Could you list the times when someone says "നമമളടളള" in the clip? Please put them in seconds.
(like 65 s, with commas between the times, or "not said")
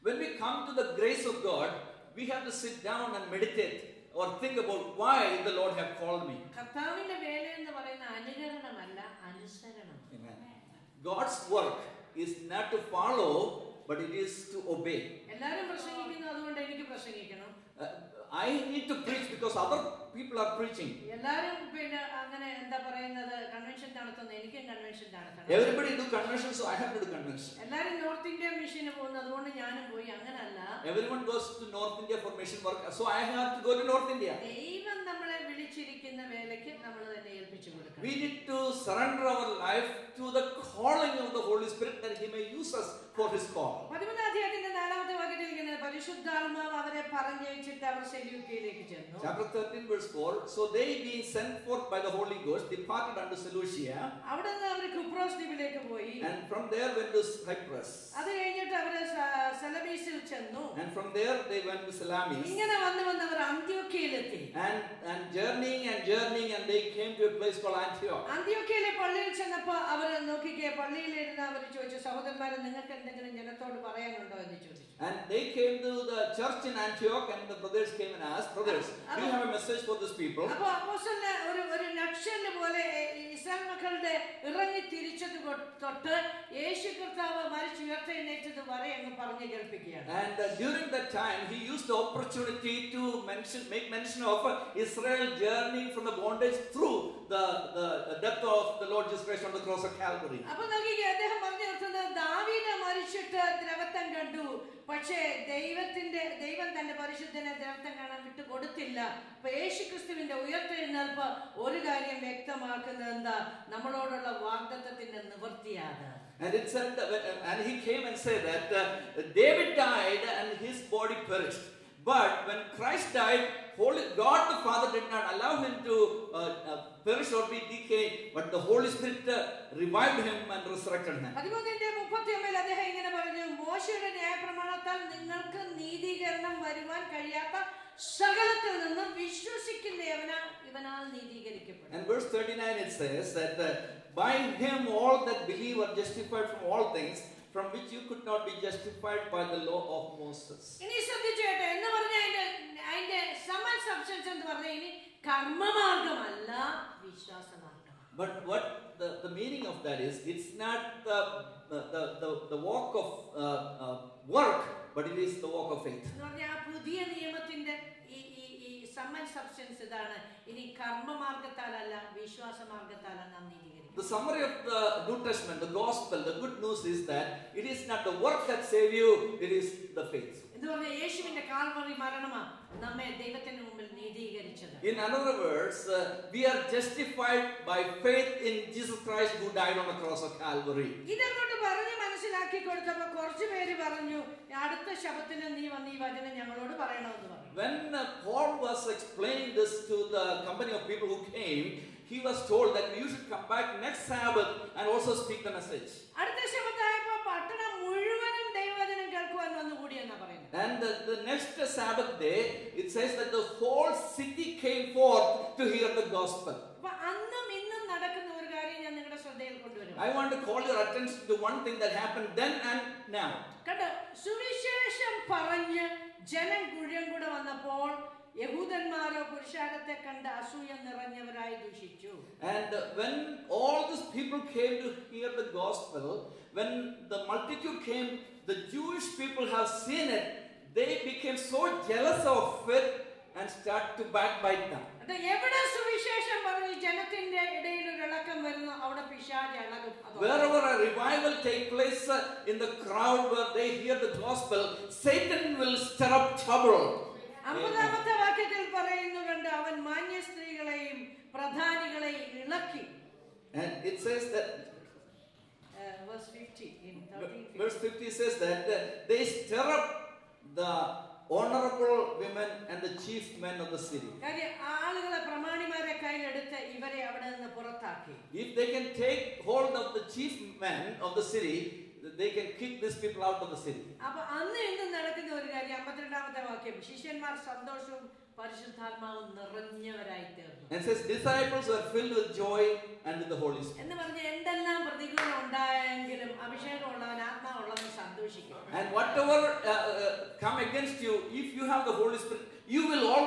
113 s.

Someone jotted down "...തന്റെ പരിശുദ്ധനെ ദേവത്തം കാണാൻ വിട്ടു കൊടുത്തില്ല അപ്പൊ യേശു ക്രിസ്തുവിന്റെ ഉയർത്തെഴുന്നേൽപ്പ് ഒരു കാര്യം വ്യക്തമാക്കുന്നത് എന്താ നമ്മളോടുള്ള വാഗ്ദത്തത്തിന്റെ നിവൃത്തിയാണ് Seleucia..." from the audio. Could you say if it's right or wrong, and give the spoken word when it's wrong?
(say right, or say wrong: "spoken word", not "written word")
wrong: "And", not "Seleucia".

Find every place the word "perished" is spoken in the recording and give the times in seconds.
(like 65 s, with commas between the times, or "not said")
121 s, 127 s.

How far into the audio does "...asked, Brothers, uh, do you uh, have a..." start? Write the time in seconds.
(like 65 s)
78 s.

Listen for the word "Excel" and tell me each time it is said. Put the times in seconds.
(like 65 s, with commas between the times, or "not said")
not said.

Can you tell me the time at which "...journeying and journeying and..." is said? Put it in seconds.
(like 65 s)
65 s.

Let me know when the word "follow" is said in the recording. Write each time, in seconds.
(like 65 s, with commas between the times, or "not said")
12 s.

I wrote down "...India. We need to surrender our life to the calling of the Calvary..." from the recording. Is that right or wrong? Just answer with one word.
wrong.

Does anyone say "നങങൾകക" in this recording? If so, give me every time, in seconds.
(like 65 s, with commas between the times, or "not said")
72 s, 135 s.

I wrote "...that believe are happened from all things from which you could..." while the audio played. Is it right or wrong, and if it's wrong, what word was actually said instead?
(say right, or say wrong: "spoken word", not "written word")
wrong: "justified", not "happened".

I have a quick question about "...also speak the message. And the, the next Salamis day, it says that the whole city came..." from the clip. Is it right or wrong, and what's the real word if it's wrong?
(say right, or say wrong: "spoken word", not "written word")
wrong: "Sabbath", not "Salamis".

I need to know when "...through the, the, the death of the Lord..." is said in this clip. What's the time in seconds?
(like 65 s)
96 s.